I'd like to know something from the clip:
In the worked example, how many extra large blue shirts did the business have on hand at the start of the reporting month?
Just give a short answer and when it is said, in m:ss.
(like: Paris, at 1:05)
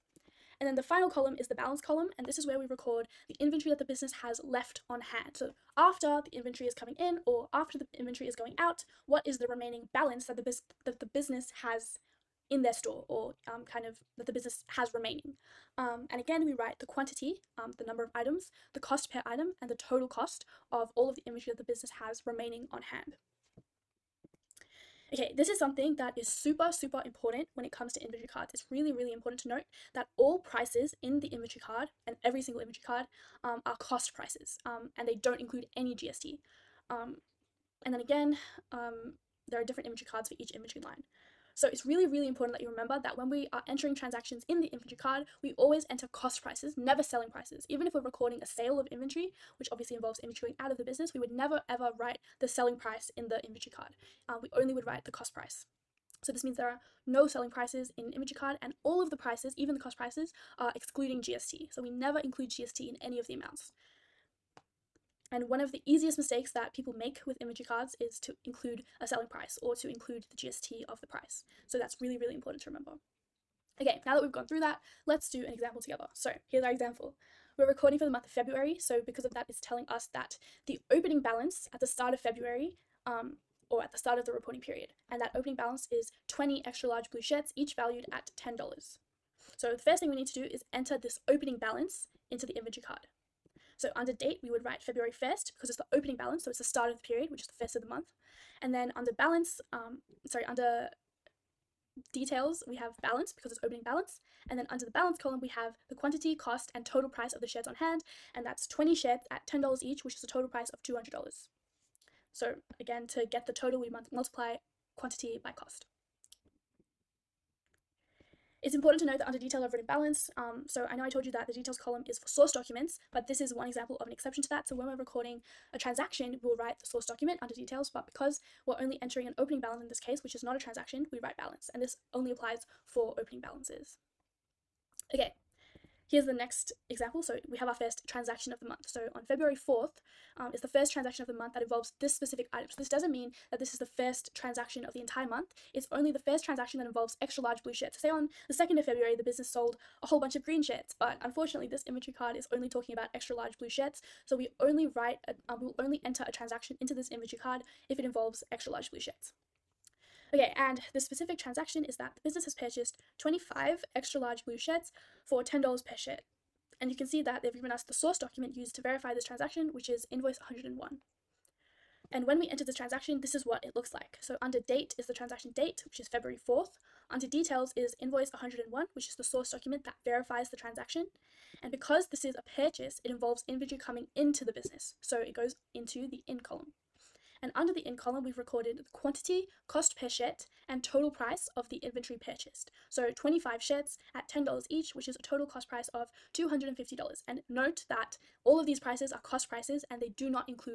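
20, at 1:26.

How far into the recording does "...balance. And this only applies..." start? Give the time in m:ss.
2:11.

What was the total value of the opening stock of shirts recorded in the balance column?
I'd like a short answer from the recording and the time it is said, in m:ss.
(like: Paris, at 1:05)
$200, at 1:50.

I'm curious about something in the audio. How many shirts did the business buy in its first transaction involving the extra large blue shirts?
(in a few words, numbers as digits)
25.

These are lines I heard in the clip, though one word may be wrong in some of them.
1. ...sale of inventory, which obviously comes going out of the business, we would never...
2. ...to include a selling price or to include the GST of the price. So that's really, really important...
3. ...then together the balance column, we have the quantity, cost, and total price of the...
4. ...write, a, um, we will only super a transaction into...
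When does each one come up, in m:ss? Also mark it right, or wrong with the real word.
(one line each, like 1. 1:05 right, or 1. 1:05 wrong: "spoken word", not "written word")
1. 0:48 wrong: "involves", not "comes"
2. 1:08 right
3. 1:44 wrong: "under", not "together"
4. 2:34 wrong: "enter", not "super".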